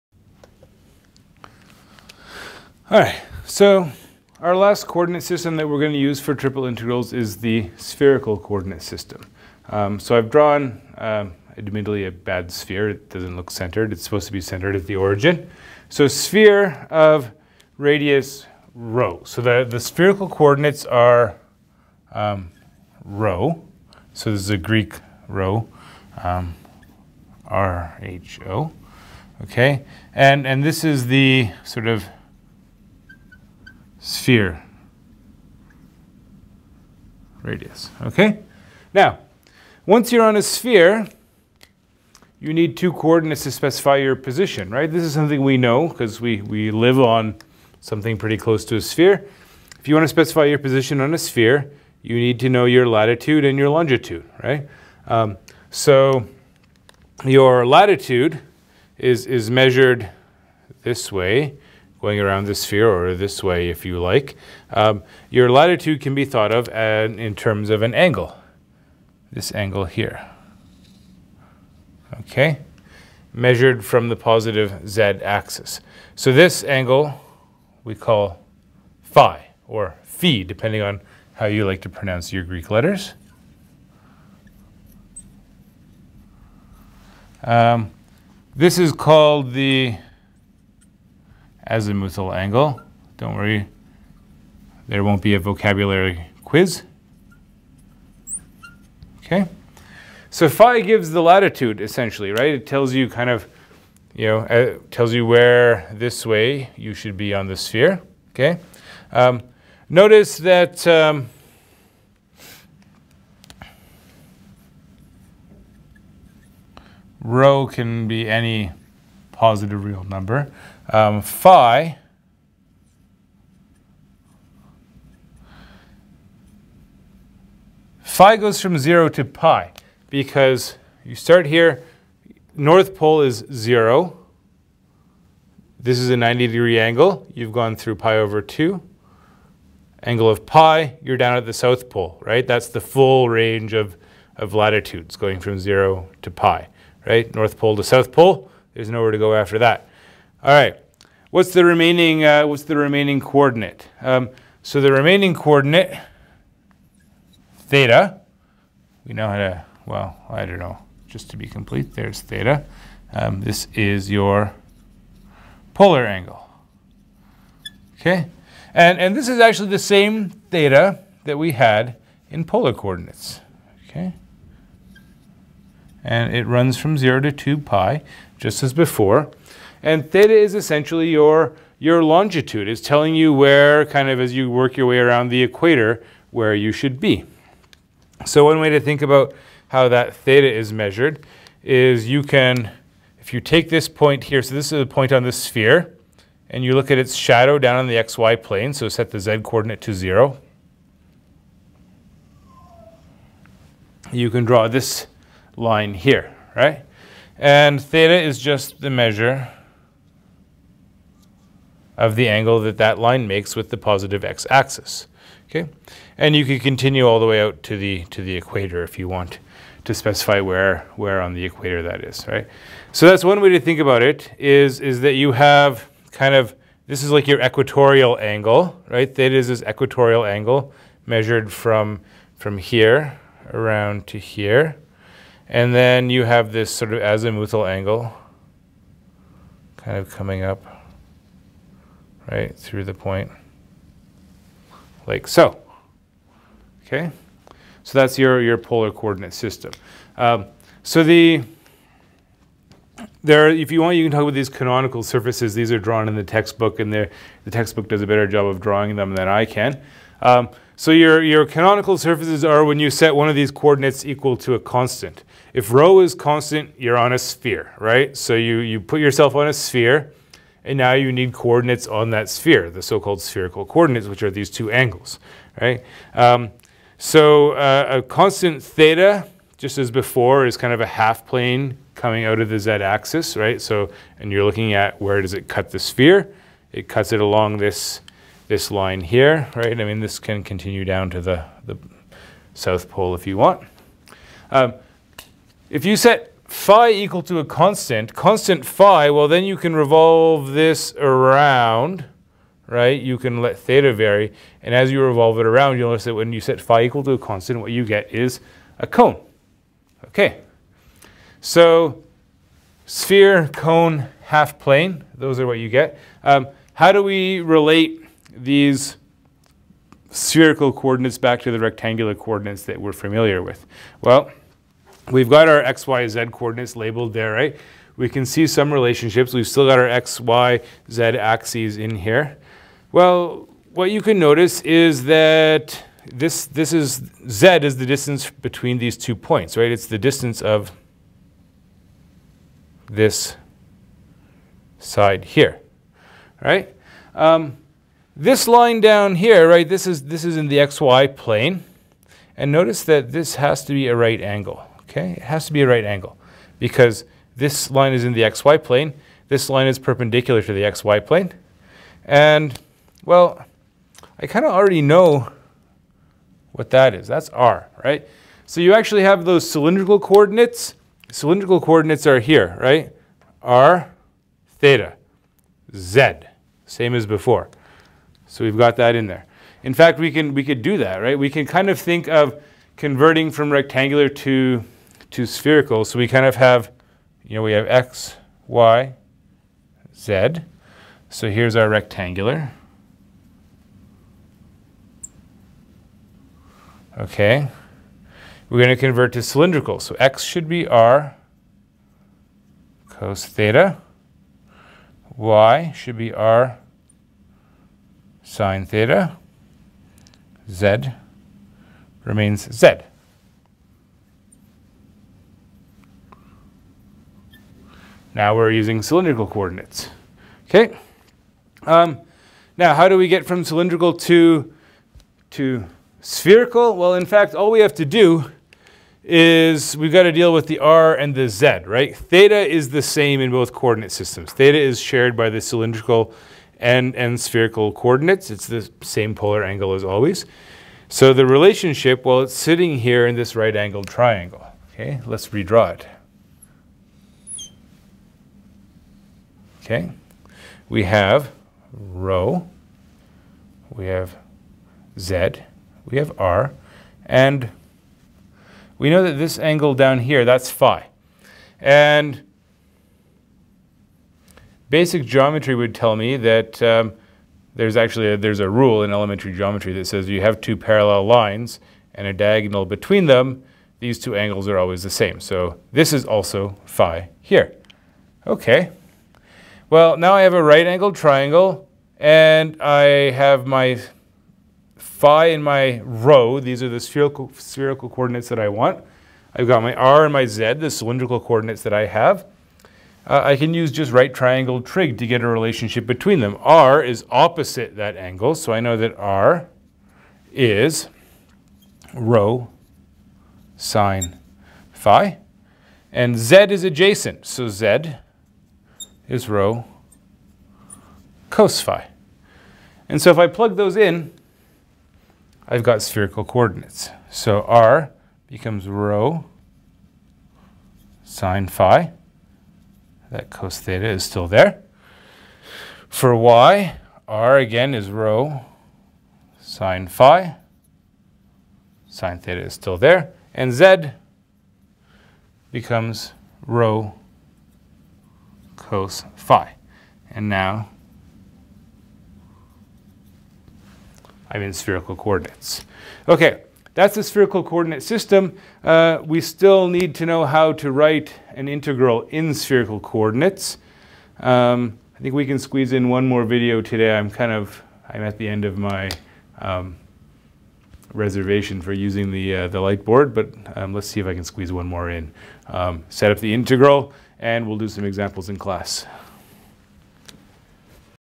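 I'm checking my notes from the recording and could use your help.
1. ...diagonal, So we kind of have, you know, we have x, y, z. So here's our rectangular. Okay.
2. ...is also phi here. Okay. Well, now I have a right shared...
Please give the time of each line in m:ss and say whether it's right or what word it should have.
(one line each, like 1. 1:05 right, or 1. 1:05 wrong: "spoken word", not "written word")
1. 6:25 wrong: "spherical", not "diagonal"
2. 7:55 wrong: "angled", not "shared".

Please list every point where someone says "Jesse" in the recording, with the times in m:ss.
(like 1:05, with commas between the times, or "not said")
not said.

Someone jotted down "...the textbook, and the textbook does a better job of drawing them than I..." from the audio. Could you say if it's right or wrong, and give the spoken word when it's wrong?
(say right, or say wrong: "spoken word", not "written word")
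right.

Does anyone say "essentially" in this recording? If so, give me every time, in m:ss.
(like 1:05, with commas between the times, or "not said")
1:41, 3:00.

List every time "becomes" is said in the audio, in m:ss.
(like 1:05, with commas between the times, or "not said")
8:38, 8:55.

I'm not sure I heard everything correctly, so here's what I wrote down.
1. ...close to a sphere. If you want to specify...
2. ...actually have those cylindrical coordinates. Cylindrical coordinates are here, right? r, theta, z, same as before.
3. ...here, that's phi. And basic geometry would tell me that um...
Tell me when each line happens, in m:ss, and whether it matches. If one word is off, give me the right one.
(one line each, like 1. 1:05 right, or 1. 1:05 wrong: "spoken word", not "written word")
1. 0:48 right
2. 6:08 right
3. 7:39 right.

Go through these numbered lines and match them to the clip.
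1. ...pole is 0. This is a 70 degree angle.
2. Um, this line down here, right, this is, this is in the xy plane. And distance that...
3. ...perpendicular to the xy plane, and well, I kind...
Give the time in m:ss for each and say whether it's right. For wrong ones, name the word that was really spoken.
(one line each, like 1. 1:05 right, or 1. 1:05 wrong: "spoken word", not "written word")
1. 2:12 wrong: "90", not "70"
2. 5:47 wrong: "notice", not "distance"
3. 5:59 right.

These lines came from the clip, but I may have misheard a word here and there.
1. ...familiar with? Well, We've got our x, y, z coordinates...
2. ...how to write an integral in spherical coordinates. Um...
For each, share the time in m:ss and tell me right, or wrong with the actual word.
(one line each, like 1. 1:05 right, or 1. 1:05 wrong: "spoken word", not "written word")
1. 5:22 right
2. 9:10 right.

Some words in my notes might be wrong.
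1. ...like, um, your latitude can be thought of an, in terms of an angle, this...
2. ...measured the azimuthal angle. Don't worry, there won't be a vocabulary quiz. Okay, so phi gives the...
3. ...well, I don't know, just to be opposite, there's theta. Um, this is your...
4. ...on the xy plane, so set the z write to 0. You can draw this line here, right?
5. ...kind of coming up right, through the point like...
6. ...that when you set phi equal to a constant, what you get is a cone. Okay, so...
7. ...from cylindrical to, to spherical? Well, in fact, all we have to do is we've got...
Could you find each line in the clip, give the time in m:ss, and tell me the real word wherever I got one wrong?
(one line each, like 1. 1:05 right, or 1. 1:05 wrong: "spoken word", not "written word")
1. 1:03 right
2. 1:28 wrong: "called", not "measured"
3. 2:39 wrong: "complete", not "opposite"
4. 3:17 wrong: "coordinate", not "write"
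5. 3:59 right
6. 5:06 right
7. 7:03 right.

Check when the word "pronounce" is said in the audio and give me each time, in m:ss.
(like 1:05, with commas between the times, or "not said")
1:21.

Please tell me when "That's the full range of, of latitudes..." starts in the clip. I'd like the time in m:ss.
2:22.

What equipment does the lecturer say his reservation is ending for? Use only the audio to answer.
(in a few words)
light board.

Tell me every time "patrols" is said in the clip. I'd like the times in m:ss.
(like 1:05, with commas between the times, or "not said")
not said.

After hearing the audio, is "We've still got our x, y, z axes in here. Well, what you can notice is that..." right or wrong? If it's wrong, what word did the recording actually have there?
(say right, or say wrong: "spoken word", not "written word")
right.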